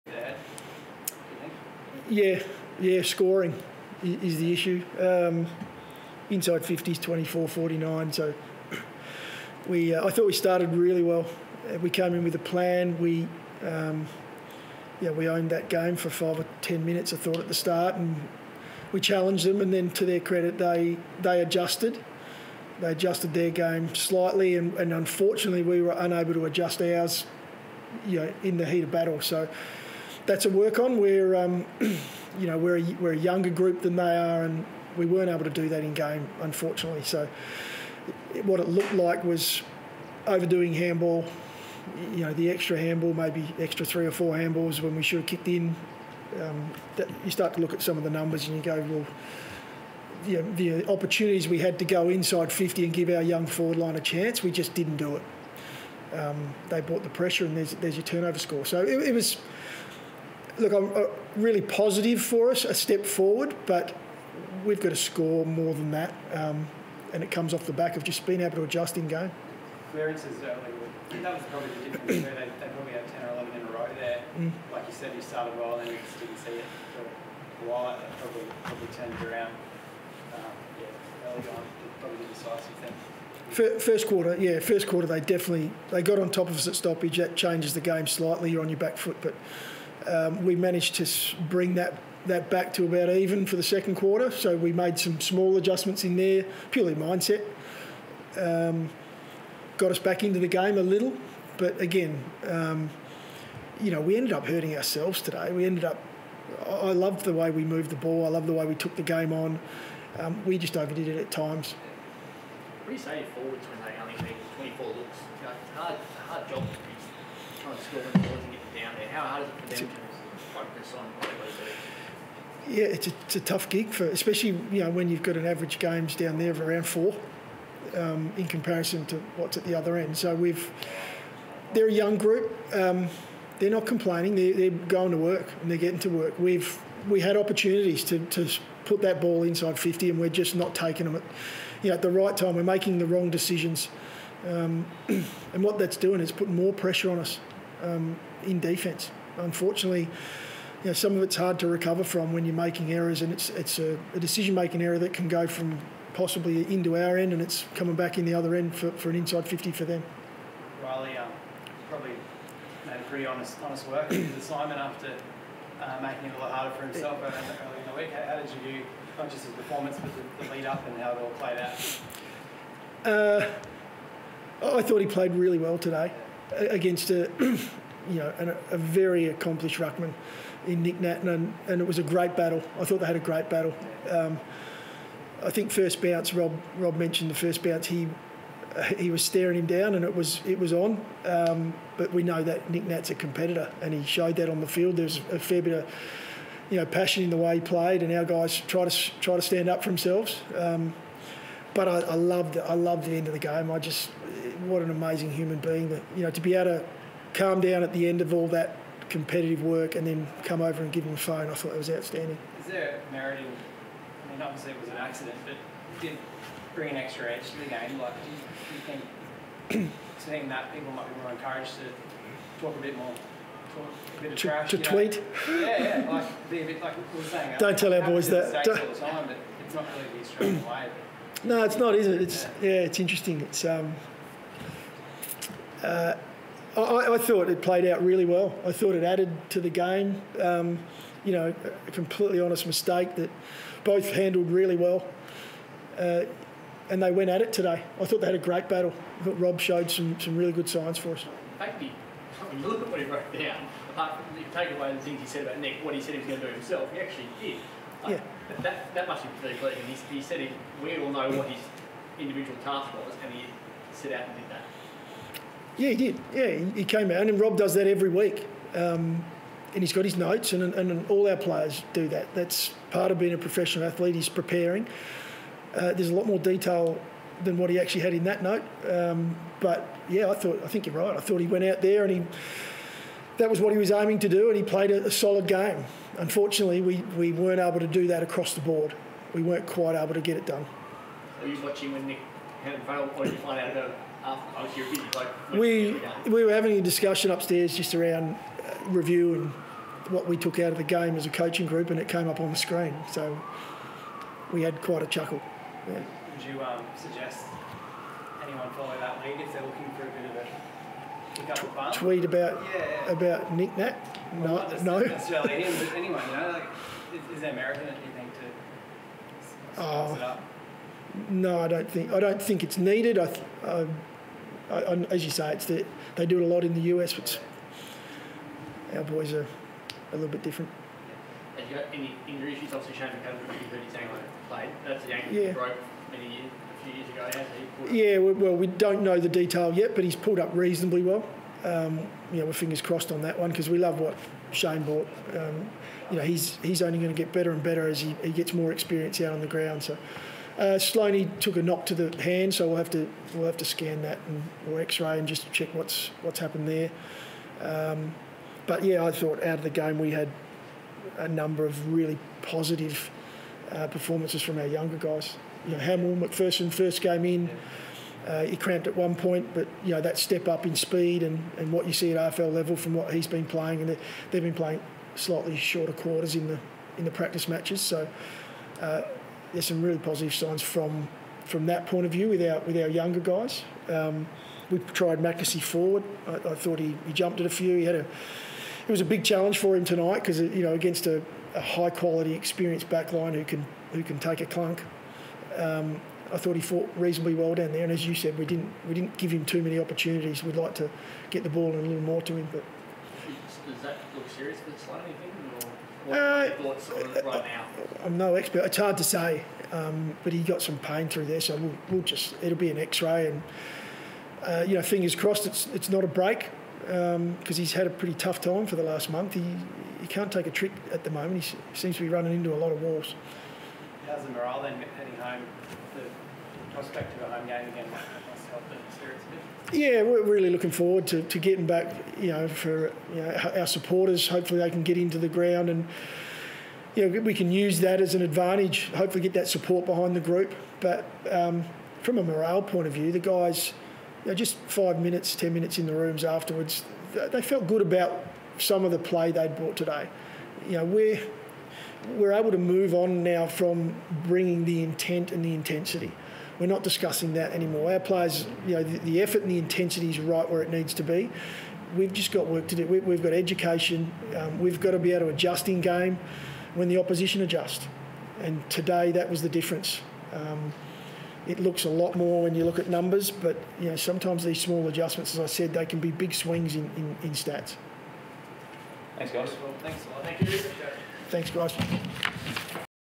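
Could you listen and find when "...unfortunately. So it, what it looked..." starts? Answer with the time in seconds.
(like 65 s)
36 s.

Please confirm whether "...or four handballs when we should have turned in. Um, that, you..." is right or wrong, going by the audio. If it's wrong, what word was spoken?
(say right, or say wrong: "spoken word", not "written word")
wrong: "kicked", not "turned".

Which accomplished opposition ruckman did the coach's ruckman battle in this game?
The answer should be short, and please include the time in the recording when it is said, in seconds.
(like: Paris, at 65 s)
Nic Naitanui, at 180 s.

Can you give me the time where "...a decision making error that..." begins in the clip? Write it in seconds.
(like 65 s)
154 s.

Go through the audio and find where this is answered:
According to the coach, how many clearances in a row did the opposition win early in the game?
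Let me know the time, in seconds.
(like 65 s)
73 s.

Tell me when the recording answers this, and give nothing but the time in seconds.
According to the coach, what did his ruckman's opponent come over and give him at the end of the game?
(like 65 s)
211 s.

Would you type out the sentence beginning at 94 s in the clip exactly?
So we made some small adjustments in there, purely mindset.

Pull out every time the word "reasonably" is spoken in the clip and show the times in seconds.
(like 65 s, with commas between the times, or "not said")
340 s, 396 s.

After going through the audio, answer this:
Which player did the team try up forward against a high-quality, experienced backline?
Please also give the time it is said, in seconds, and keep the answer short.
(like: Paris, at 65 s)
McAsey, at 385 s.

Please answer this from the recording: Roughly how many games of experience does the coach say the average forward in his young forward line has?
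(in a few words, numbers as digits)
around 4.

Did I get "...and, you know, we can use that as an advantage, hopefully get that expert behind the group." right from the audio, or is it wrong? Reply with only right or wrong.
wrong.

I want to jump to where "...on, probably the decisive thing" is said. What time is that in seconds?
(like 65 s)
81 s.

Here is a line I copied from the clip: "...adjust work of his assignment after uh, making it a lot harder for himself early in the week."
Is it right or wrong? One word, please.
wrong.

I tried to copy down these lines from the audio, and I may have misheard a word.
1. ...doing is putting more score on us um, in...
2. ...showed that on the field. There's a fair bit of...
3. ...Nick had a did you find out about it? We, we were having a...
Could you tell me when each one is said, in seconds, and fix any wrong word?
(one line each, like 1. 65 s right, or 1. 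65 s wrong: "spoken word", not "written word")
1. 145 s wrong: "pressure", not "score"
2. 194 s right
3. 292 s right.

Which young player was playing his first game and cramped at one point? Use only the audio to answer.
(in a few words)
Hamill McPherson.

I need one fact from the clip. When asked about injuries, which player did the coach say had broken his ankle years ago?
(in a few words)
Shane McAdam.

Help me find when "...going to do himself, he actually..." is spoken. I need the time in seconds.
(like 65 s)
256 s.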